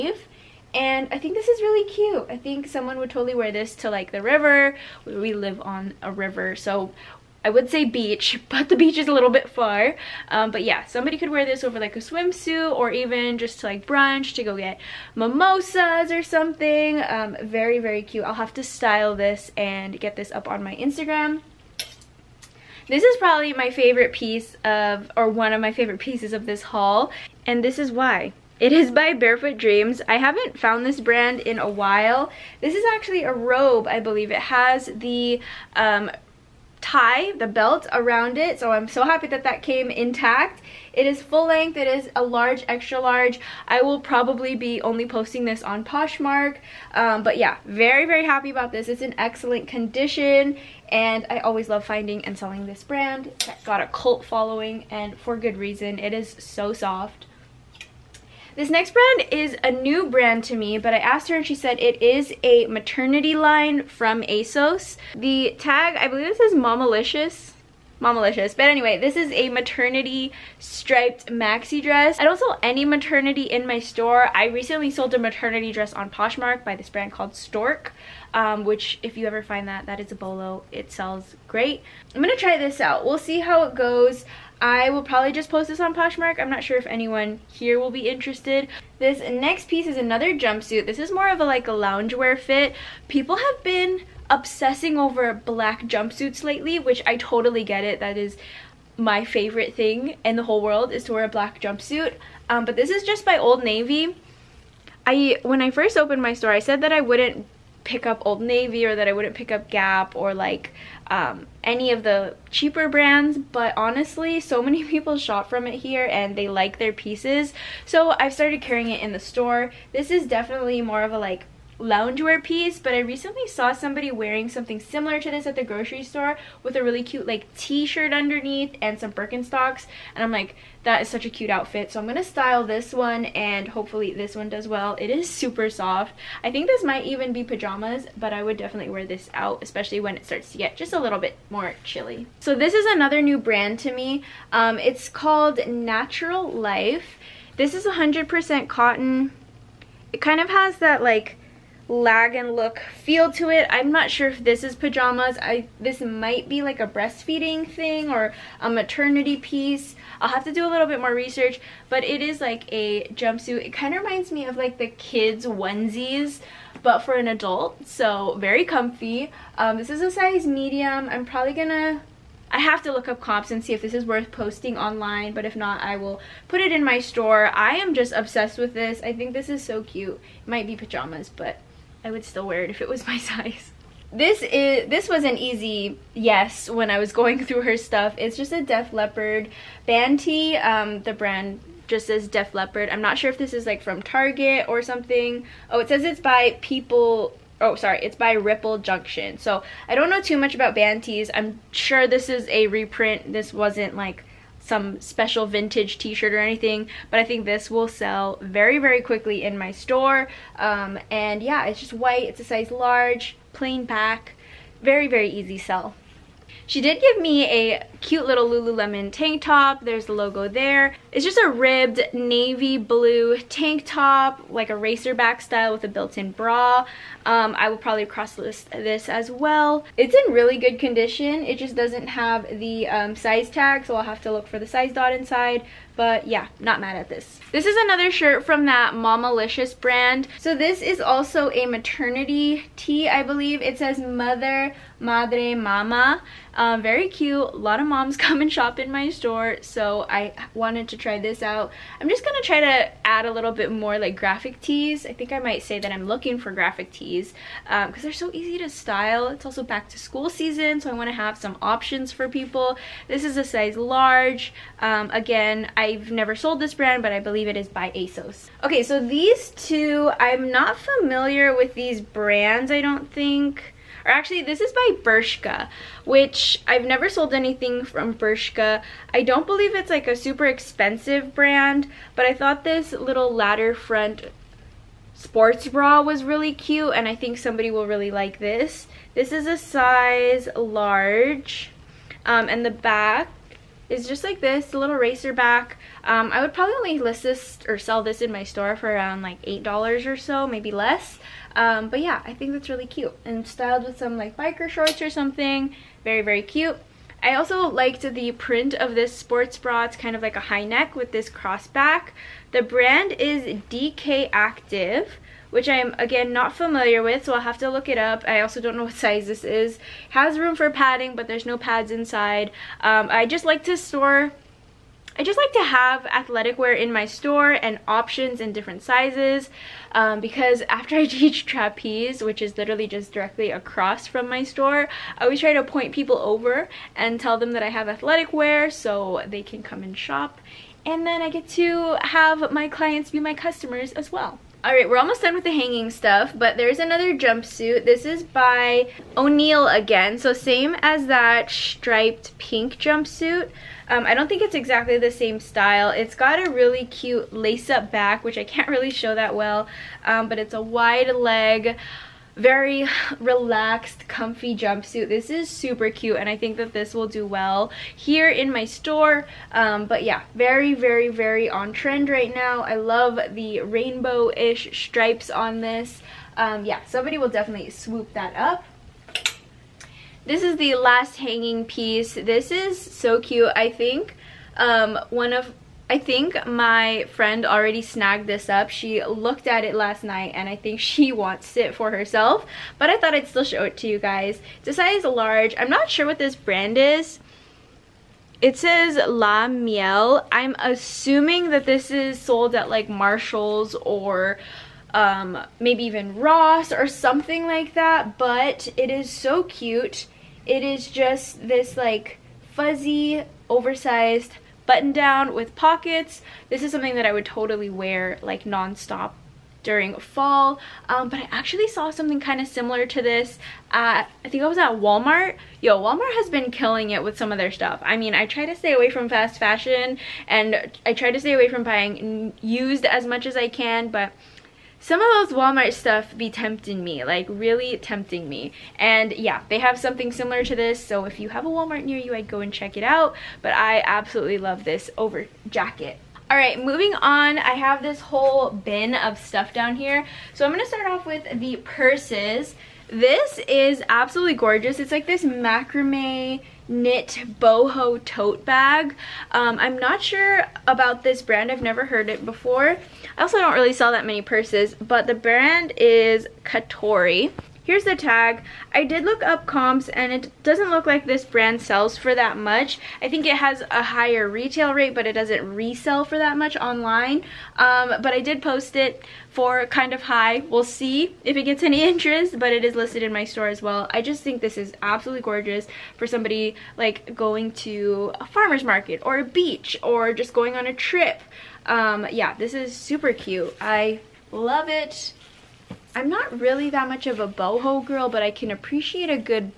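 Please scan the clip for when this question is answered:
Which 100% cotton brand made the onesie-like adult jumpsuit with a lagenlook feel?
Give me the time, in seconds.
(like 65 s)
145 s.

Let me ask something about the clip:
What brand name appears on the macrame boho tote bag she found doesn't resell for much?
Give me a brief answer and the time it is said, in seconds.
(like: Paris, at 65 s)
Katori, at 466 s.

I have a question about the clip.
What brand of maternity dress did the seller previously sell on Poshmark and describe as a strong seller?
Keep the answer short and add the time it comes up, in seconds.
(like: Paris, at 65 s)
Storq, at 77 s.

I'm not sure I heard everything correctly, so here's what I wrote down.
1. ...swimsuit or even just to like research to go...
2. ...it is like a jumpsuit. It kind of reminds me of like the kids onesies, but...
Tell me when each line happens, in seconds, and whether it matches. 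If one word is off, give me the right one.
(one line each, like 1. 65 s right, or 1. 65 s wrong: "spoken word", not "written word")
1. 11 s wrong: "brunch", not "research"
2. 162 s right.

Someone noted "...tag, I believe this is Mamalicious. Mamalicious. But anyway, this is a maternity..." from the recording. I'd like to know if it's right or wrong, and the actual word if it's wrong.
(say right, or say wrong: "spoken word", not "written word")
right.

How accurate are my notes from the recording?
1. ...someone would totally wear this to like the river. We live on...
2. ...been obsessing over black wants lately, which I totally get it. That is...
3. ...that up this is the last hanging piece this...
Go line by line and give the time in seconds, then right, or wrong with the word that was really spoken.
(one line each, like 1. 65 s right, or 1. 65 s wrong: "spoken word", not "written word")
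1. 2 s right
2. 93 s wrong: "jumpsuits", not "wants"
3. 378 s right.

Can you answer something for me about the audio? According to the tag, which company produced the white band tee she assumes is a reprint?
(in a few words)
Ripple Junction.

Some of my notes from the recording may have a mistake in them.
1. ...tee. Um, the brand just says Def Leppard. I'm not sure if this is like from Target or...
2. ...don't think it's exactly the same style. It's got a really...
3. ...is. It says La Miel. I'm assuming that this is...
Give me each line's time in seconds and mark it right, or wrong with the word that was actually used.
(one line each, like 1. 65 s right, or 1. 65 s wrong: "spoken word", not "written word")
1. 190 s right
2. 354 s right
3. 396 s right.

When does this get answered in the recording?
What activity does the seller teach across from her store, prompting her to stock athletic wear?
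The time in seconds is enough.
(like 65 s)
331 s.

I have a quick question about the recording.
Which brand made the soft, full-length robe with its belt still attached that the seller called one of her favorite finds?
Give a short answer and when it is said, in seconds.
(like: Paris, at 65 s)
Barefoot Dreams, at 29 s.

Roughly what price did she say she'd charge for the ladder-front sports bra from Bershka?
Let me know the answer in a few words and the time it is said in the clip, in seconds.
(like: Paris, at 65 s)
$8, at 299 s.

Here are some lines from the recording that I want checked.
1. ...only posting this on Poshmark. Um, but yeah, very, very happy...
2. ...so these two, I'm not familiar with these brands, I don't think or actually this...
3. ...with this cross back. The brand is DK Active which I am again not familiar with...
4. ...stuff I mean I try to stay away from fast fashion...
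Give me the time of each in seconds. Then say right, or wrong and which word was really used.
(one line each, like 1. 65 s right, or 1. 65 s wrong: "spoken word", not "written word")
1. 44 s right
2. 268 s right
3. 310 s right
4. 427 s right.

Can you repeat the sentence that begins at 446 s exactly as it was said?
All right, moving on, I have this whole bin of stuff down here.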